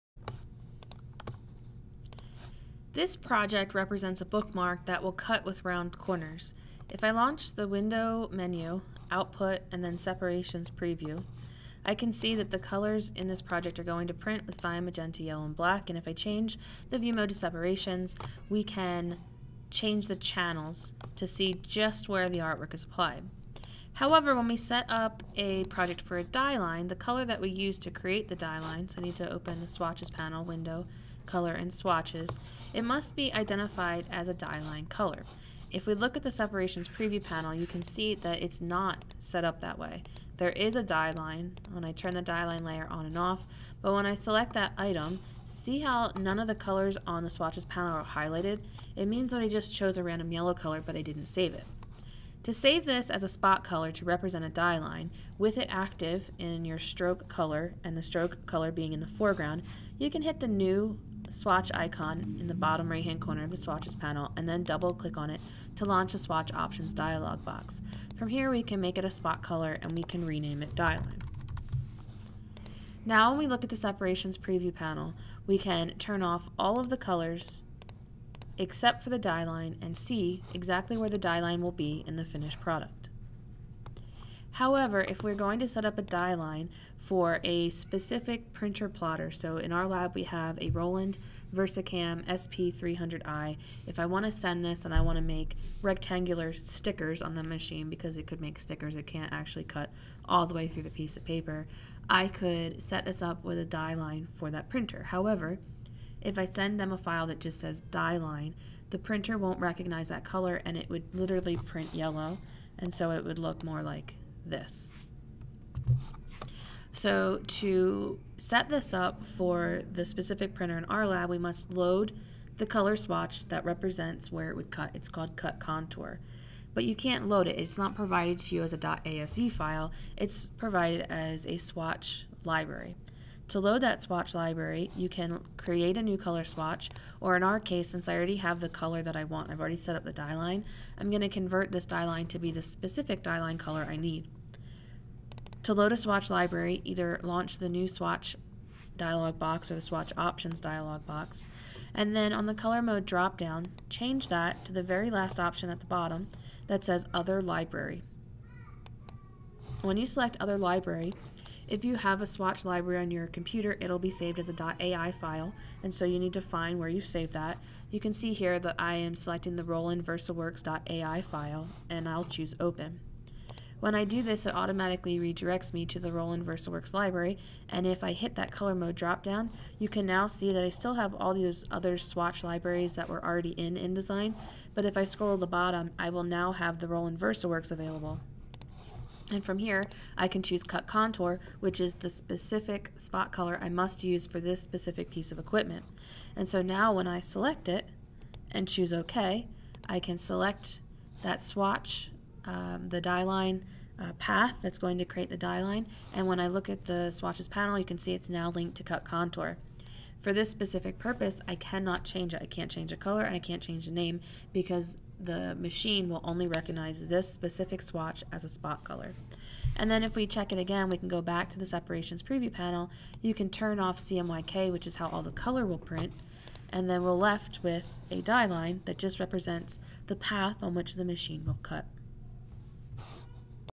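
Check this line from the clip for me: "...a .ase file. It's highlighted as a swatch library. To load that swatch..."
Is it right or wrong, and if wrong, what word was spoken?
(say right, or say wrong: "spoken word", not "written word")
wrong: "provided", not "highlighted".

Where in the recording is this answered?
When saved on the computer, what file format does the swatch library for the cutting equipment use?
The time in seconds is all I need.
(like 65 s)
164 s.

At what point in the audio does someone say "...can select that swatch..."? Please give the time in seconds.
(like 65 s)
199 s.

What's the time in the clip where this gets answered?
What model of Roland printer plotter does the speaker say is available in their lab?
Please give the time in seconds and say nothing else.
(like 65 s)
90 s.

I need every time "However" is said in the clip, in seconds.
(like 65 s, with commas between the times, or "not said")
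23 s, 84 s, 105 s.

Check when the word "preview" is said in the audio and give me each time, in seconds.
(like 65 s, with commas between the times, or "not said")
10 s, 36 s, 74 s, 222 s.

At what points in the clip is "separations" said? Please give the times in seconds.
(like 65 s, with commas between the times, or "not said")
9 s, 17 s, 36 s, 73 s, 221 s.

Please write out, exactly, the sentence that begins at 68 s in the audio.
From here we can make it a spot color and we can rename it die line.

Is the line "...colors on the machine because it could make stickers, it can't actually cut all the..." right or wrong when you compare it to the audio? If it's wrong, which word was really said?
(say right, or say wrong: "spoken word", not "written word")
wrong: "stickers", not "colors".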